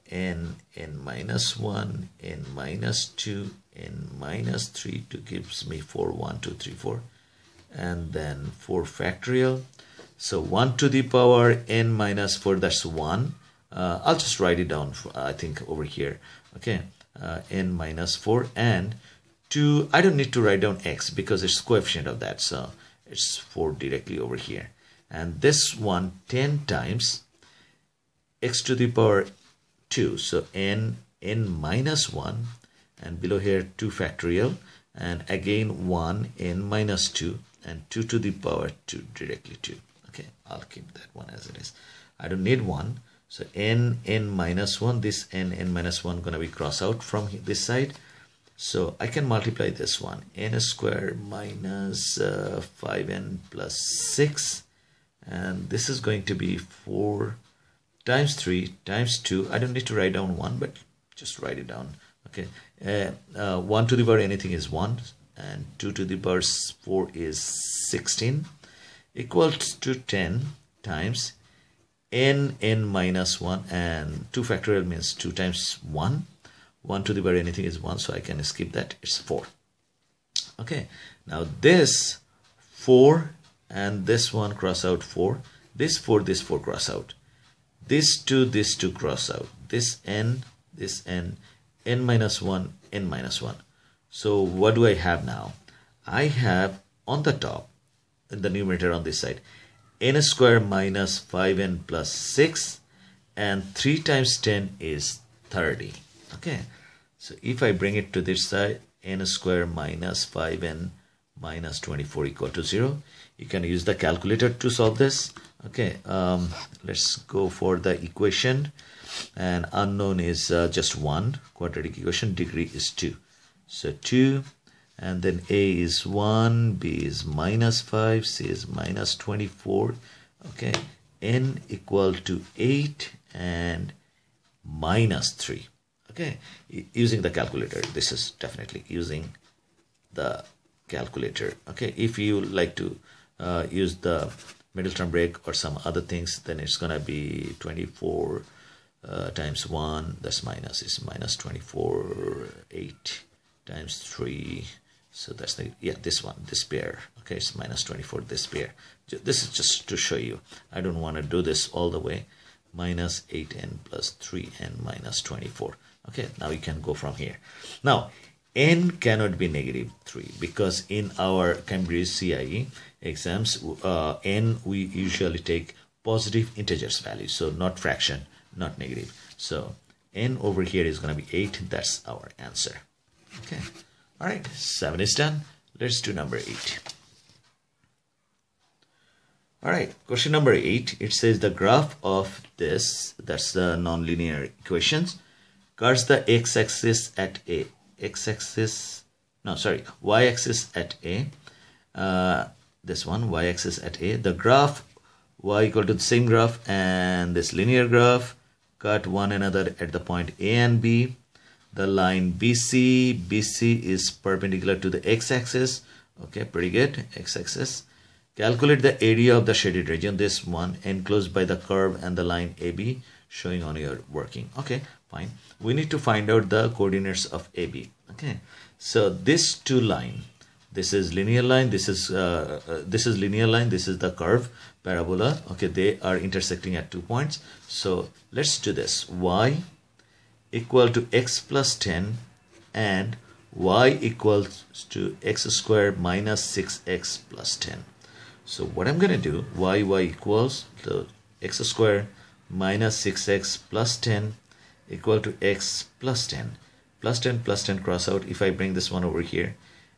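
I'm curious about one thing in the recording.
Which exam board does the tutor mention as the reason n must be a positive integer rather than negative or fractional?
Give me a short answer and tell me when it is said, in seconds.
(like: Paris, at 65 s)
Cambridge CIE, at 171 s.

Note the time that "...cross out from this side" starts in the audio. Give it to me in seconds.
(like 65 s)
46 s.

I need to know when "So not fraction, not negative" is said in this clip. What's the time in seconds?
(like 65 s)
177 s.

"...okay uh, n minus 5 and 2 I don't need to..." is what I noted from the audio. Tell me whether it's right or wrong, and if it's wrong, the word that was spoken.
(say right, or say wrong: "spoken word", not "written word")
wrong: "4", not "5".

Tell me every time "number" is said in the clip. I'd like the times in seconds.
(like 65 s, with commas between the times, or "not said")
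186 s, 190 s.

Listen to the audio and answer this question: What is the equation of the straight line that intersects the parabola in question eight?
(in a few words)
y = x + 10.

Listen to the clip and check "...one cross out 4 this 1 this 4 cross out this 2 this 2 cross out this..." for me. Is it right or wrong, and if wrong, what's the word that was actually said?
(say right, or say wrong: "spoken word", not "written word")
wrong: "4", not "1".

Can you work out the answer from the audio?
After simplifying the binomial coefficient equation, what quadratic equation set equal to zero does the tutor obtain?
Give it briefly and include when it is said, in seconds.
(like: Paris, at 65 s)
n^2 - 5n - 24 = 0, at 109 s.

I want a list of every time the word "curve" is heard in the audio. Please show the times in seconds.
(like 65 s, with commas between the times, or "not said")
221 s, 234 s.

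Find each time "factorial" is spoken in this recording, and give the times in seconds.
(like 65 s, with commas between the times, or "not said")
8 s, 33 s, 74 s.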